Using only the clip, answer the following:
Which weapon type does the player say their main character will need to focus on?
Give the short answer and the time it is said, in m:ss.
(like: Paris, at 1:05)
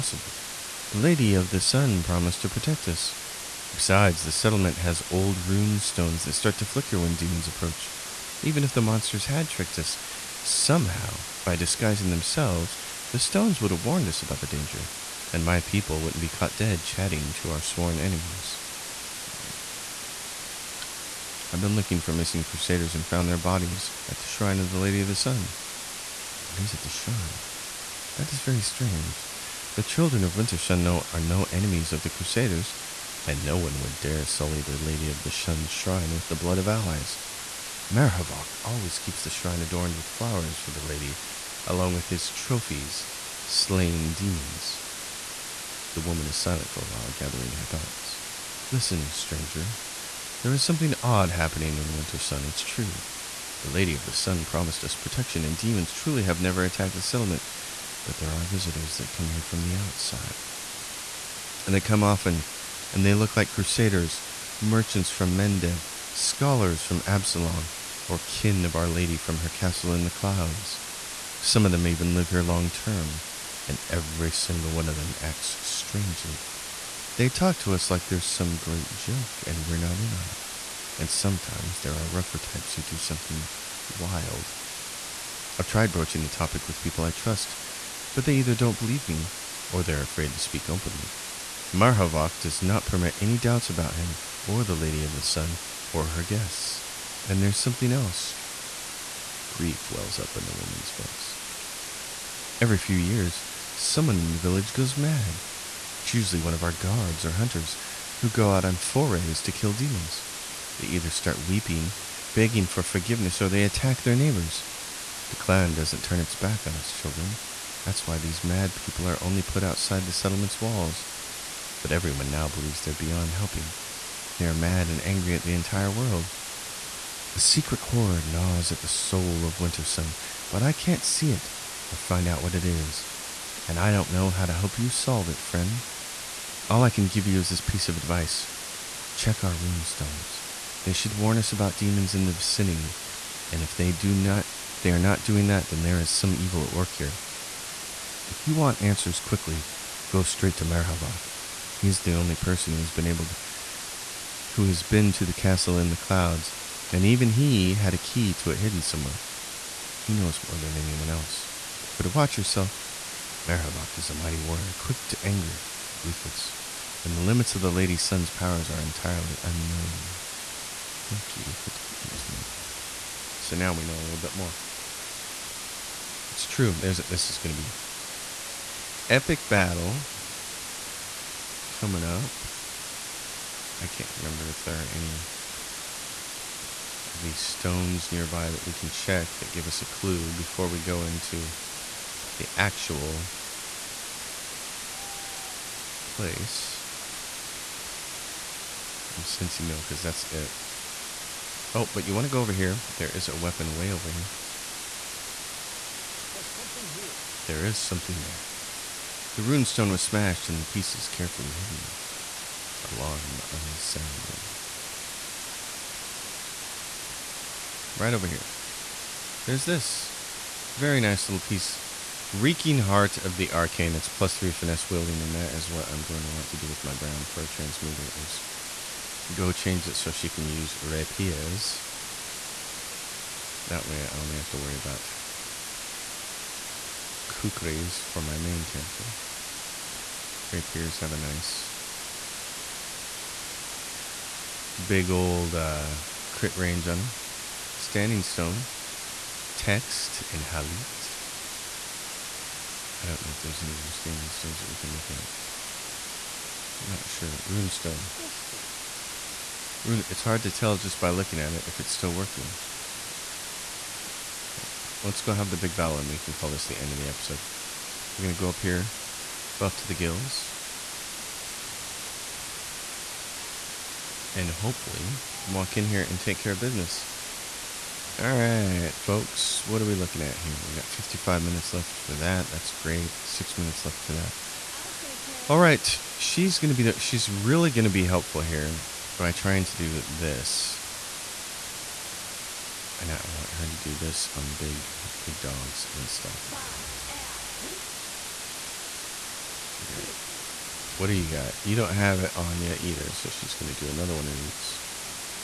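Kukris, at 3:57.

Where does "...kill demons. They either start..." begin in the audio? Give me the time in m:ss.
1:49.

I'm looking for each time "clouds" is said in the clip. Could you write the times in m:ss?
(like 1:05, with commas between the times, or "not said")
1:10, 2:35.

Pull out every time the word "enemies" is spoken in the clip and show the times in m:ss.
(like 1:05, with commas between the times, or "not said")
0:17, 0:31.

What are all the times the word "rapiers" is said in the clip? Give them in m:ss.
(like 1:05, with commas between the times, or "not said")
3:50, 4:00.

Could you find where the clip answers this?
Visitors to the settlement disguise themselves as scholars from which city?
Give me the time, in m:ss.
1:06.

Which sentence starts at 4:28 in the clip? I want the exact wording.
We're going to go up here, buff to the gills.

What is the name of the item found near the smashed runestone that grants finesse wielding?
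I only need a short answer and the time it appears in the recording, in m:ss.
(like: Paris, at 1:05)
Reeking Heart of the Arcane, at 3:42.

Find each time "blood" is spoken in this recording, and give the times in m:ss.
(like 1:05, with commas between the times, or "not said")
0:36.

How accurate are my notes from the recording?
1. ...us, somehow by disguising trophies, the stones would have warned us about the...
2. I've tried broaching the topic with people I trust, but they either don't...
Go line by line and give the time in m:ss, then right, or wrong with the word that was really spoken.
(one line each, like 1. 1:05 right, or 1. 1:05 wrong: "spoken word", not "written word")
1. 0:09 wrong: "themselves", not "trophies"
2. 1:25 right.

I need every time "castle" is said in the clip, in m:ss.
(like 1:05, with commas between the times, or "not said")
1:09, 2:35.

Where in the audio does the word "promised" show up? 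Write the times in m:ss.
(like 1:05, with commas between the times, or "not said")
0:02, 0:54.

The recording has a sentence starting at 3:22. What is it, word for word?
There is a weapon way over here.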